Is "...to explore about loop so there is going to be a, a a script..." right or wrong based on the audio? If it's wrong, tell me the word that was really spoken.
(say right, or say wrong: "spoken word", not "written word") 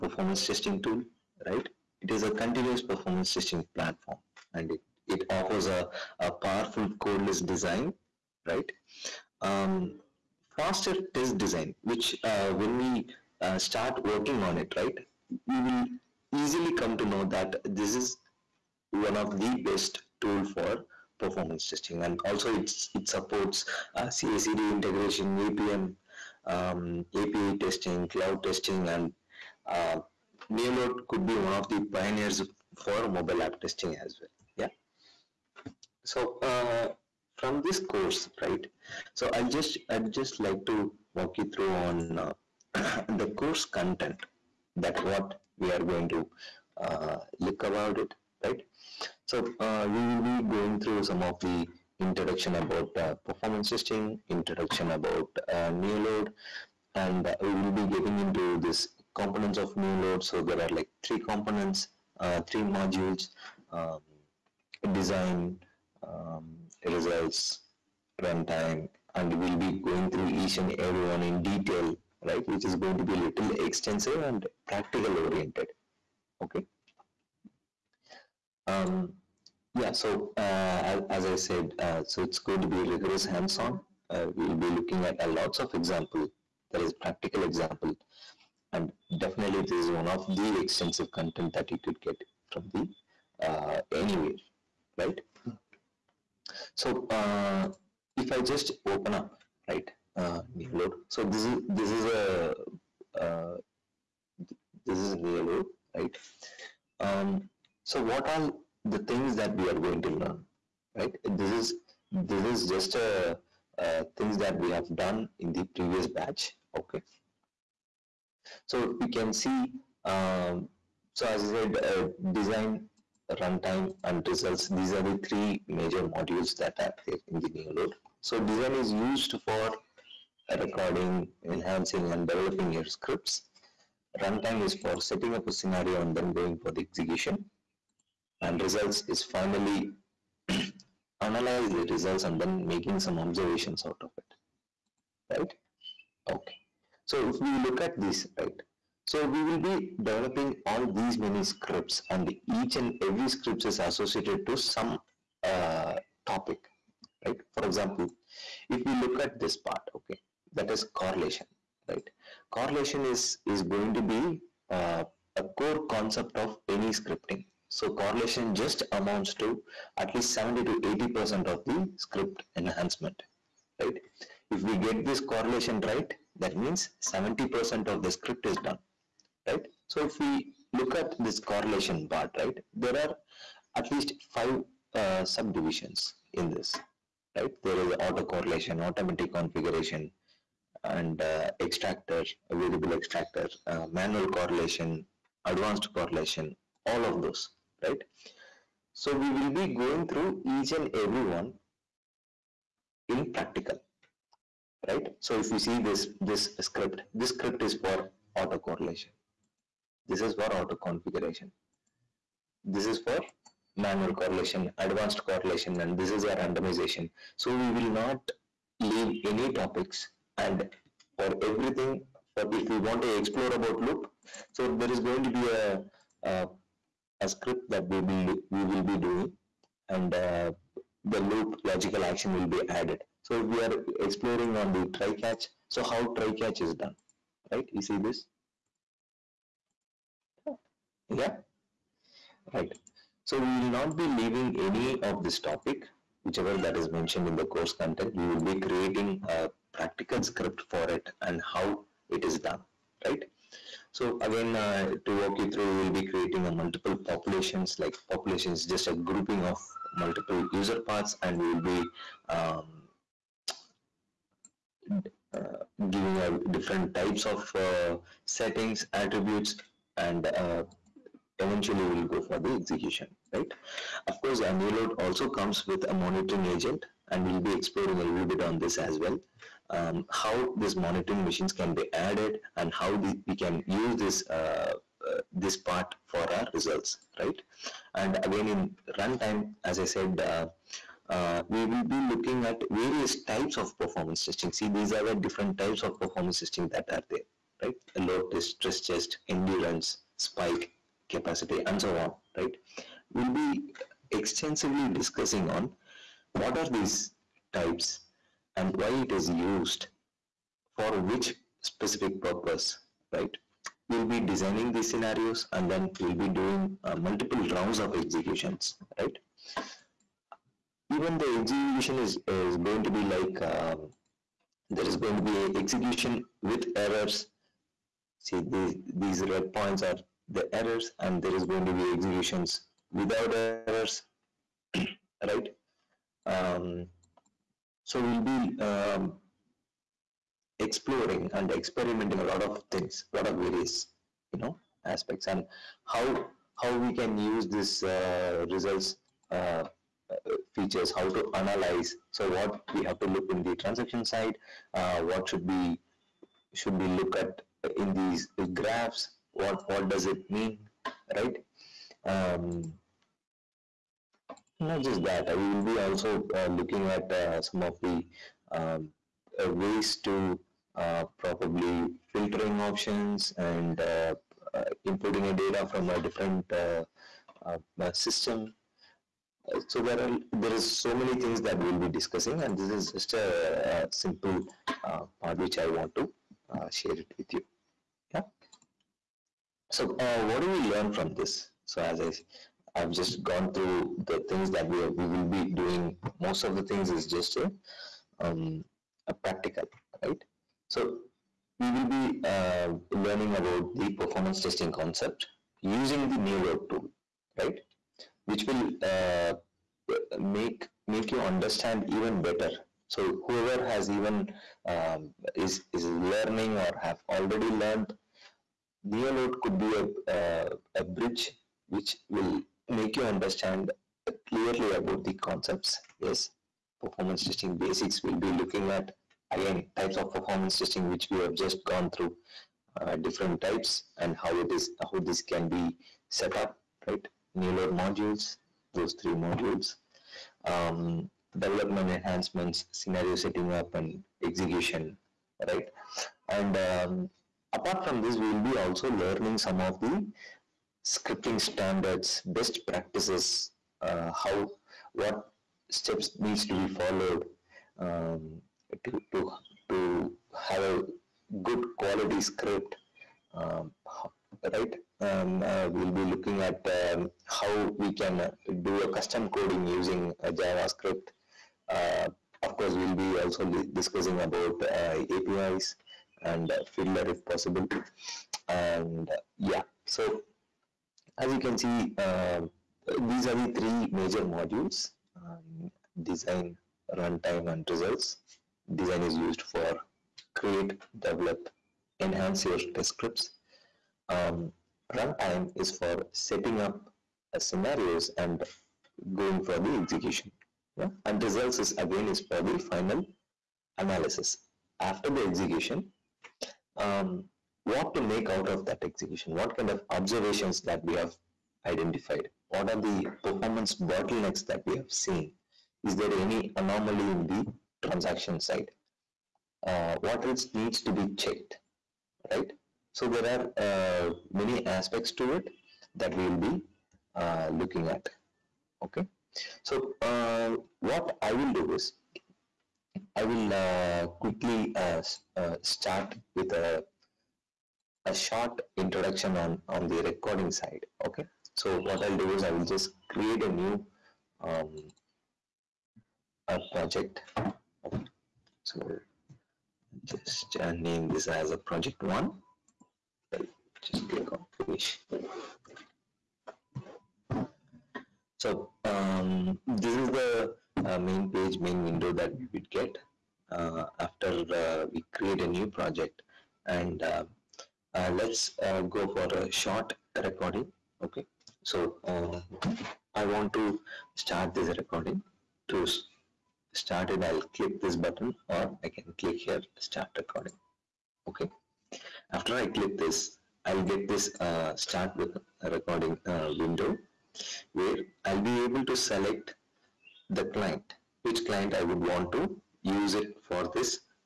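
right.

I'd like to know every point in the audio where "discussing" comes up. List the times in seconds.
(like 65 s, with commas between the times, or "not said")
304 s, 381 s, 473 s.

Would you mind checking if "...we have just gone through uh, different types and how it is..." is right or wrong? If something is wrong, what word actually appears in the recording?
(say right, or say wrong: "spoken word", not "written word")
right.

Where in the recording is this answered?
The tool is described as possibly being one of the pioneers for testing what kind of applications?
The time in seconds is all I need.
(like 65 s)
33 s.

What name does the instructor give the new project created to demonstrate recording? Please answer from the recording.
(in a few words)
project one.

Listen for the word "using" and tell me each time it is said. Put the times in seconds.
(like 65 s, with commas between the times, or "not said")
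405 s, 469 s.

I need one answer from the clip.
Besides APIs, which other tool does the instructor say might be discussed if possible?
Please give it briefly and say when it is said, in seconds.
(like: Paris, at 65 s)
Fiddler, at 476 s.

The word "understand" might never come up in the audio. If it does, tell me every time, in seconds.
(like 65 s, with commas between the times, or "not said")
411 s, 423 s.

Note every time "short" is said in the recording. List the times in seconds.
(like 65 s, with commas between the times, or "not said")
538 s, 569 s.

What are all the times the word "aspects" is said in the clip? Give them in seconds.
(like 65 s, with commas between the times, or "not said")
344 s, 524 s.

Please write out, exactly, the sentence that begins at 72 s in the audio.
It is going to be a little extensive and practical oriented, okay?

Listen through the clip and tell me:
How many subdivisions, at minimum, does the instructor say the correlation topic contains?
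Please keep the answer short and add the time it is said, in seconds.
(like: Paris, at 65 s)
5, at 184 s.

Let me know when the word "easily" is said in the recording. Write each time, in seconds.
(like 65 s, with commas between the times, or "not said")
16 s.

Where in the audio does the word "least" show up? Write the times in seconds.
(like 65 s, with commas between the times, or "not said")
170 s, 183 s.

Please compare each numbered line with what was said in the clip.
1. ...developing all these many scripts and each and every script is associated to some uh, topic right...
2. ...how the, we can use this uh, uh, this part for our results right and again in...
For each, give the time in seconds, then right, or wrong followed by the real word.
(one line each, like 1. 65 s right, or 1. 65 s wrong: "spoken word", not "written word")
1. 150 s right
2. 282 s right.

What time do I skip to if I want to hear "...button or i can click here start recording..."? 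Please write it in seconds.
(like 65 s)
578 s.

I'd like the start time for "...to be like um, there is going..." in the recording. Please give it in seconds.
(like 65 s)
322 s.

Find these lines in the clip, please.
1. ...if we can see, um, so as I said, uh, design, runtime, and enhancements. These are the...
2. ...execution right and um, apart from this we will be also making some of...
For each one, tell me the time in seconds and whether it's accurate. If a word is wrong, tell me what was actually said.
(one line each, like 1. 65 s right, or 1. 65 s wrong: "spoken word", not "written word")
1. 118 s wrong: "results", not "enhancements"
2. 444 s wrong: "learning", not "making".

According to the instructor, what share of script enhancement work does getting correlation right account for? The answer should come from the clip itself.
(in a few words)
70 to 80%.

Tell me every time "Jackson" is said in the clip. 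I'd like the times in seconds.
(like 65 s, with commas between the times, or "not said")
not said.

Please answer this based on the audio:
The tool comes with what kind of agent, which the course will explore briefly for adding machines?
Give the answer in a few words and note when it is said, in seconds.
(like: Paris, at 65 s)
monitoring agent, at 275 s.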